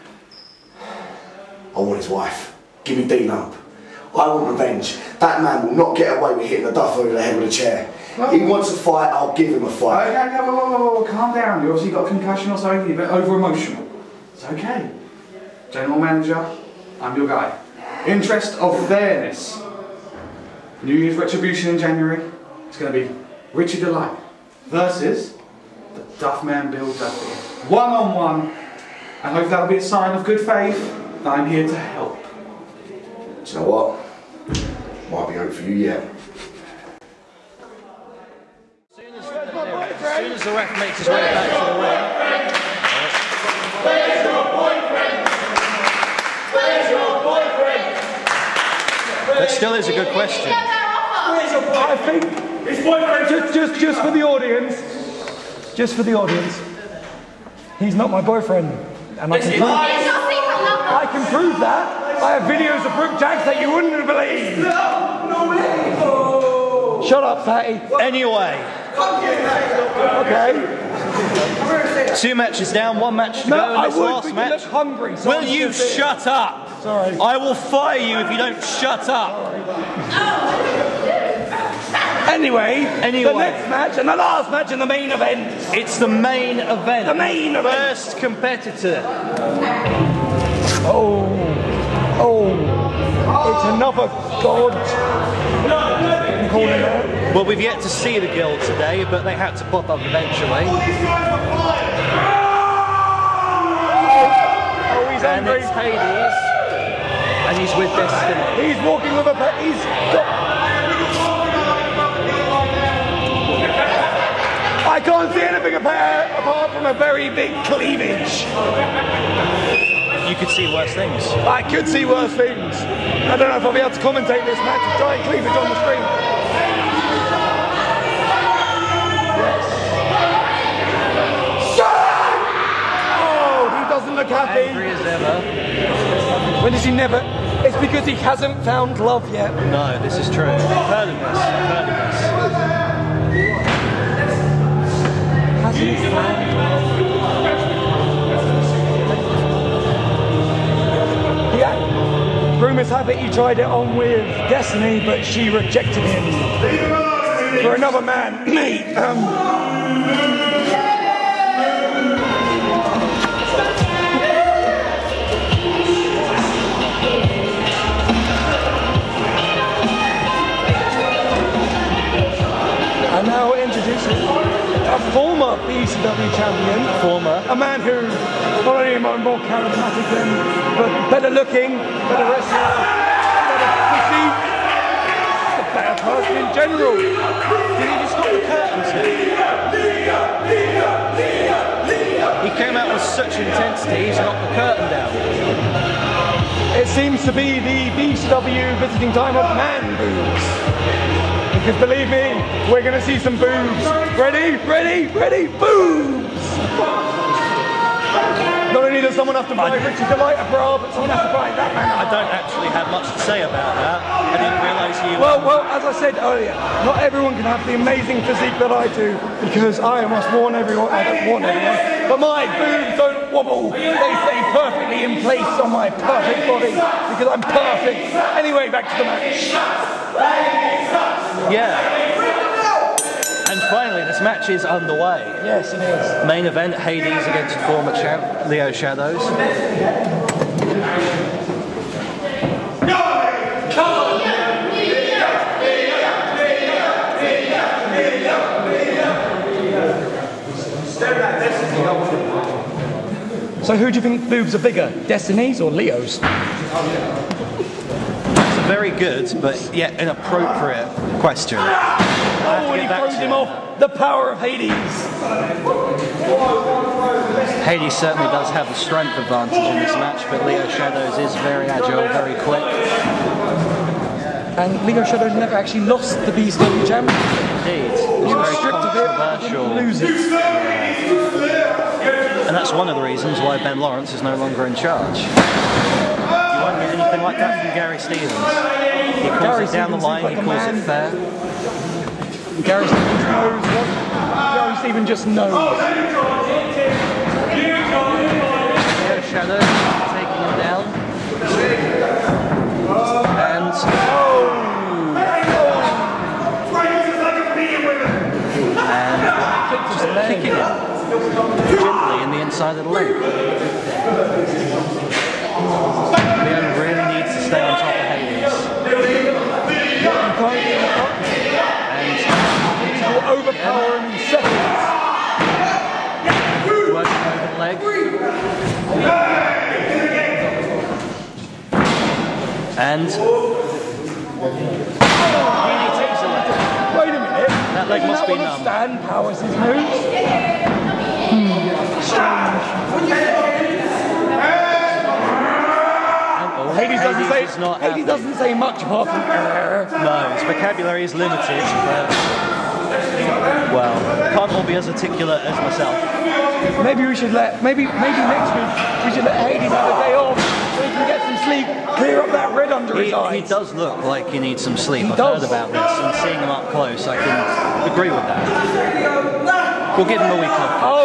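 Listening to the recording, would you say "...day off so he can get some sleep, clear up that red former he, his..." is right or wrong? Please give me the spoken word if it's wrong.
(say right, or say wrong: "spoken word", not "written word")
wrong: "under", not "former".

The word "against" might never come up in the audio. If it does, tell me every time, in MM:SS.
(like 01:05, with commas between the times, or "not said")
03:57.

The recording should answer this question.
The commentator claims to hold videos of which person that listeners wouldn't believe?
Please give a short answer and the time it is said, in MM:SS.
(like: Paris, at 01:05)
Brooke Jacks, at 01:02.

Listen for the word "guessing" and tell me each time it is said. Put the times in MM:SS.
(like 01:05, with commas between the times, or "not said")
not said.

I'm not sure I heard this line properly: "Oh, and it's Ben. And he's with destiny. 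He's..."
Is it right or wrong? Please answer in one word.
wrong.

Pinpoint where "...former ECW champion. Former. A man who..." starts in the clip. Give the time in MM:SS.
02:55.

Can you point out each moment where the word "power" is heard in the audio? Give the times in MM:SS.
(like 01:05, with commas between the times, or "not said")
04:23, 05:39.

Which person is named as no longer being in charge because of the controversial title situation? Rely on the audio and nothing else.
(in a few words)
Ben Lawrence.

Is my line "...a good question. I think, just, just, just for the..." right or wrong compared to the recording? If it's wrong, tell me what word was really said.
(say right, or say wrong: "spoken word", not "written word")
right.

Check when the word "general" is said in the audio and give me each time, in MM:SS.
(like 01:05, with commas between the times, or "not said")
00:15, 03:06.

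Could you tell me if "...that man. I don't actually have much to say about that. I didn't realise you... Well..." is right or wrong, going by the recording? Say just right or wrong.
right.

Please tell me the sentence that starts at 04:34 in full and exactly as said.
And Leo Shadows never actually lost the BSW Gem.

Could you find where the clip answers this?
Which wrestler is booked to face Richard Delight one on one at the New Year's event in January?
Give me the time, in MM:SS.
00:26.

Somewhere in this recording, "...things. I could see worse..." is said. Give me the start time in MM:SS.
02:00.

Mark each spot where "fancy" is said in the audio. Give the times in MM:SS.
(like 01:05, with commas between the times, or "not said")
not said.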